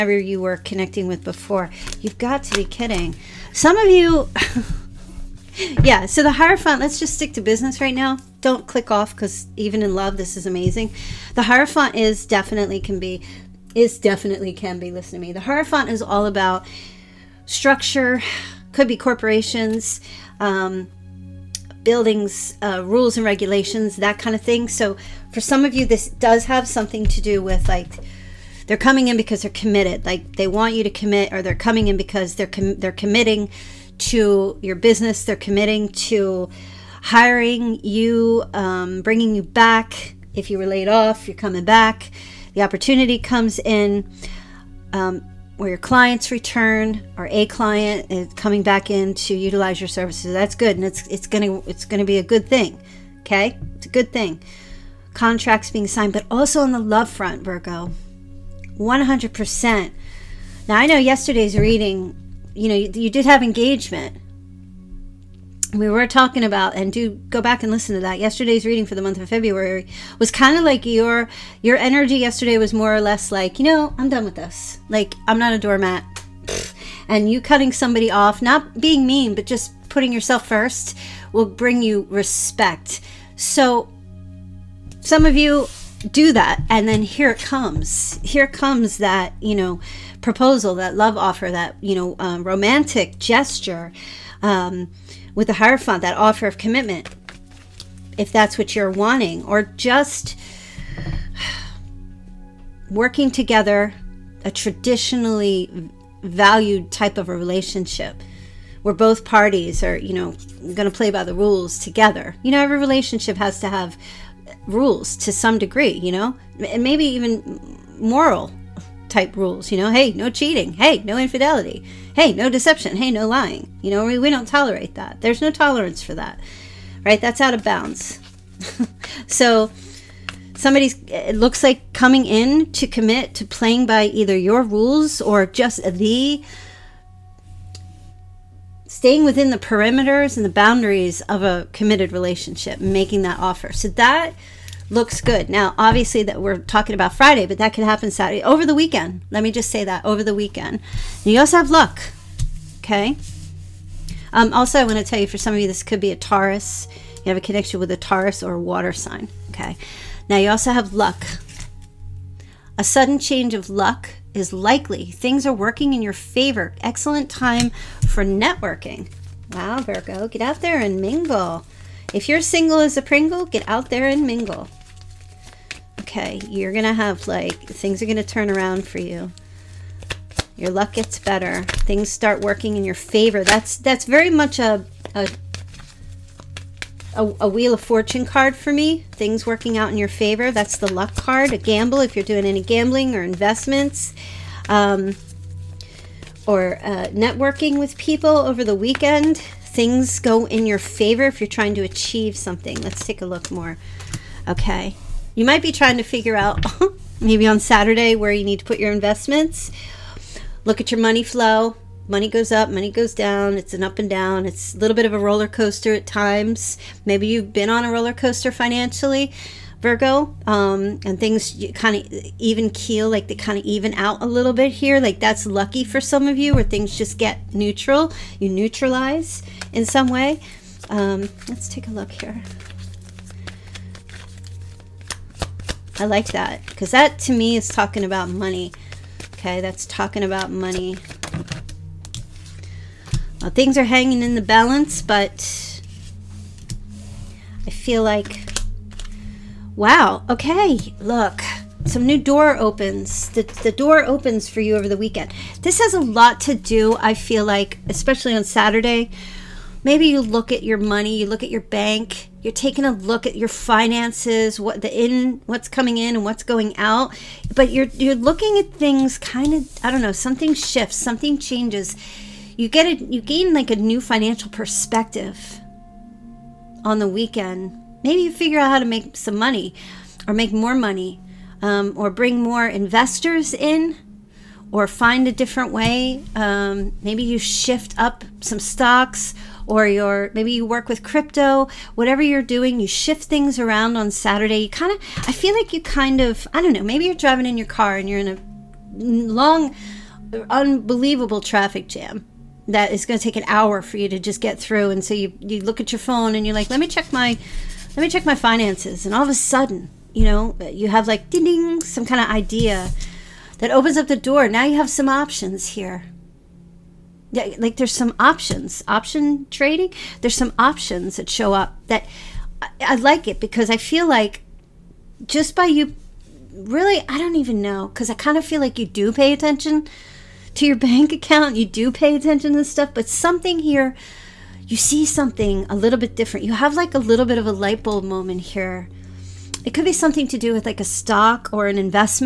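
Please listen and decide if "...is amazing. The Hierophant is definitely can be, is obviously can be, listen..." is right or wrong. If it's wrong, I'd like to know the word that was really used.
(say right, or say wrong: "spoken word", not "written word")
wrong: "definitely", not "obviously".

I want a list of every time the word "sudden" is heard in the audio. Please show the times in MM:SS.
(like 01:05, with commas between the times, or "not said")
02:42, 05:09.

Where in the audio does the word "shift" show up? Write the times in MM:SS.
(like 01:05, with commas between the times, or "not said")
04:30, 04:47, 04:52.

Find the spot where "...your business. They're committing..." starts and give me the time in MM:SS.
00:34.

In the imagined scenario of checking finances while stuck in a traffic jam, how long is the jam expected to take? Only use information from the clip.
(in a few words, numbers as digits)
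an hour.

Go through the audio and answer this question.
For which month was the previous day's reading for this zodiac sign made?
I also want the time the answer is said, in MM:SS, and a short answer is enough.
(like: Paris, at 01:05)
February, at 01:09.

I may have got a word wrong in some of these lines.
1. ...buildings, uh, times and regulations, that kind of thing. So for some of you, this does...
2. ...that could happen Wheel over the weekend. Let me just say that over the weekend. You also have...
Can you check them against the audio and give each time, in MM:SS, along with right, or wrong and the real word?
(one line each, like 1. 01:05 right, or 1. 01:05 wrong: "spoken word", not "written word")
1. 00:21 wrong: "rules", not "times"
2. 02:27 wrong: "Saturday", not "Wheel".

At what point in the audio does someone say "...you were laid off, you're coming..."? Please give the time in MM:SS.
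00:40.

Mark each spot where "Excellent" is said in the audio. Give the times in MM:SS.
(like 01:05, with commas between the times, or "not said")
02:46.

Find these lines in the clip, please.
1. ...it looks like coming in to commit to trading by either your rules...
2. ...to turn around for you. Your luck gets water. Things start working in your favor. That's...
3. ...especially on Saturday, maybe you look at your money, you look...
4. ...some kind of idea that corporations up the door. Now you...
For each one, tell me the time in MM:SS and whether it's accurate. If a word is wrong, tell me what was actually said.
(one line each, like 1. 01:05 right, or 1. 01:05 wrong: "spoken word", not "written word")
1. 02:11 wrong: "playing", not "trading"
2. 02:58 wrong: "better", not "water"
3. 04:17 right
4. 05:11 wrong: "opens", not "corporations".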